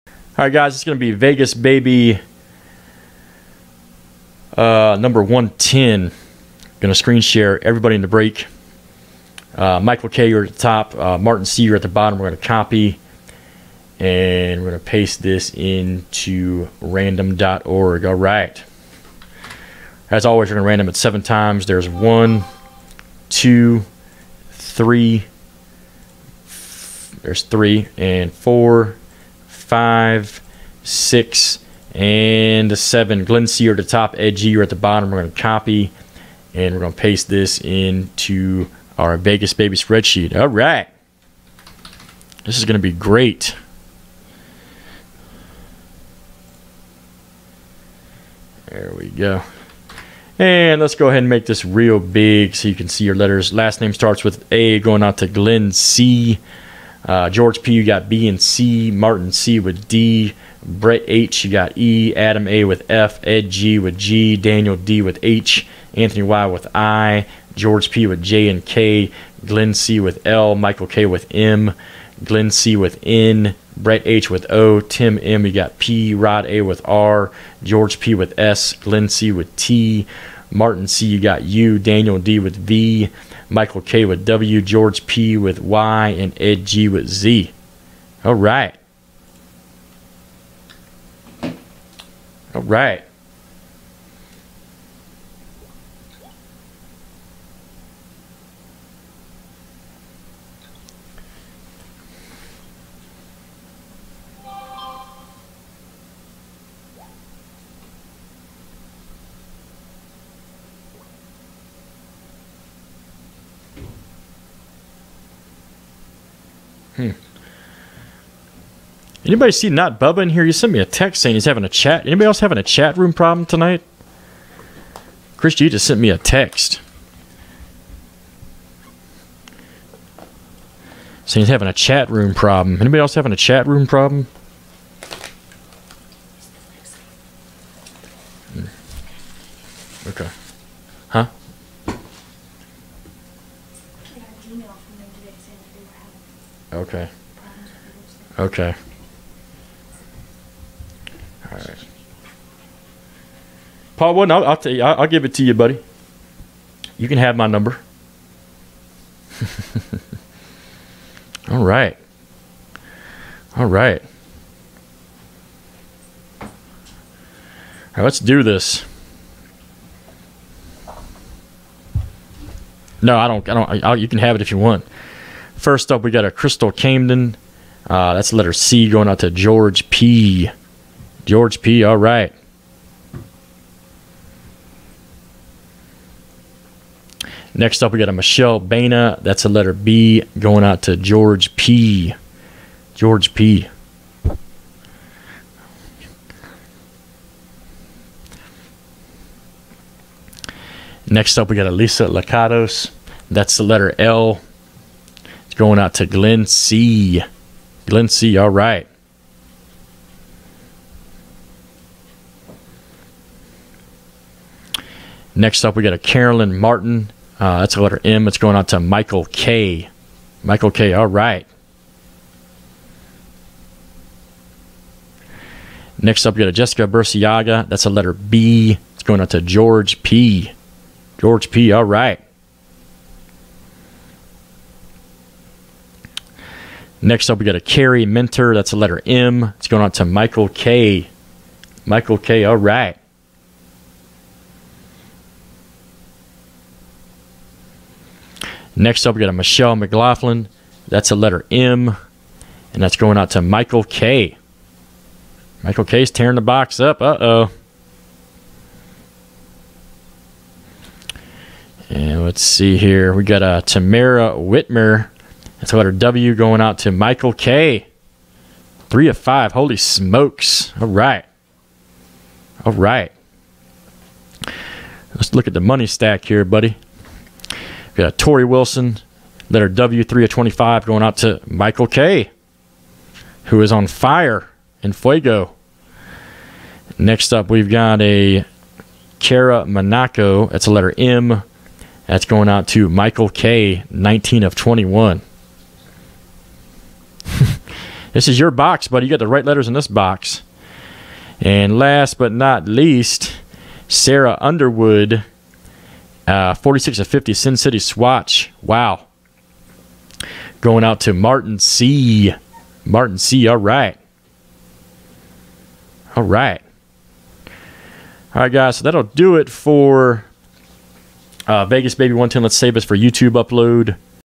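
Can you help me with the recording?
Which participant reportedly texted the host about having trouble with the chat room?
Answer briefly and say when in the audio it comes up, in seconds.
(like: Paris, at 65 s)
Chris G, at 125 s.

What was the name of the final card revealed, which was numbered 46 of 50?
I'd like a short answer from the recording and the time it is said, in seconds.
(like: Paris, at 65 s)
Sarah Underwood, at 303 s.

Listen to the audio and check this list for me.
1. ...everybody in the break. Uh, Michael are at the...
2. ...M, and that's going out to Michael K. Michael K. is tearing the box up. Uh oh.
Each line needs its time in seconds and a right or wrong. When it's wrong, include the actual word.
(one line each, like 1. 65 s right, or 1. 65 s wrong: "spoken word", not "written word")
1. 7 s right
2. 251 s right.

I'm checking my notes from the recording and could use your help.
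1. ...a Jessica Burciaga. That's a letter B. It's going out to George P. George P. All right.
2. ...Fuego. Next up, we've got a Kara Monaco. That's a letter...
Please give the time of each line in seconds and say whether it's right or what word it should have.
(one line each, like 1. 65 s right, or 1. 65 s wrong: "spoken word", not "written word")
1. 226 s right
2. 284 s right.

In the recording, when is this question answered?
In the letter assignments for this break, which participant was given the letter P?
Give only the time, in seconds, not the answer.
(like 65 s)
74 s.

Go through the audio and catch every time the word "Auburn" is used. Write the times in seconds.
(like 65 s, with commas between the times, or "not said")
not said.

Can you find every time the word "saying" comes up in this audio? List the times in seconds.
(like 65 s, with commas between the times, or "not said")
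121 s, 131 s.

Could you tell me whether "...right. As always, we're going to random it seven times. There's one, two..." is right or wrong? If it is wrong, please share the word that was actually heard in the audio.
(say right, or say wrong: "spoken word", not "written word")
right.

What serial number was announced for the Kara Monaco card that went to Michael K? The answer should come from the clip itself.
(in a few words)
19 of 21.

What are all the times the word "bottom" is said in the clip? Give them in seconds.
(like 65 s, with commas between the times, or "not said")
11 s, 34 s.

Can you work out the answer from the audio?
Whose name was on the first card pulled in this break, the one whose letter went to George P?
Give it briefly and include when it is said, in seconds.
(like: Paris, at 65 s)
Crystal Camden, at 176 s.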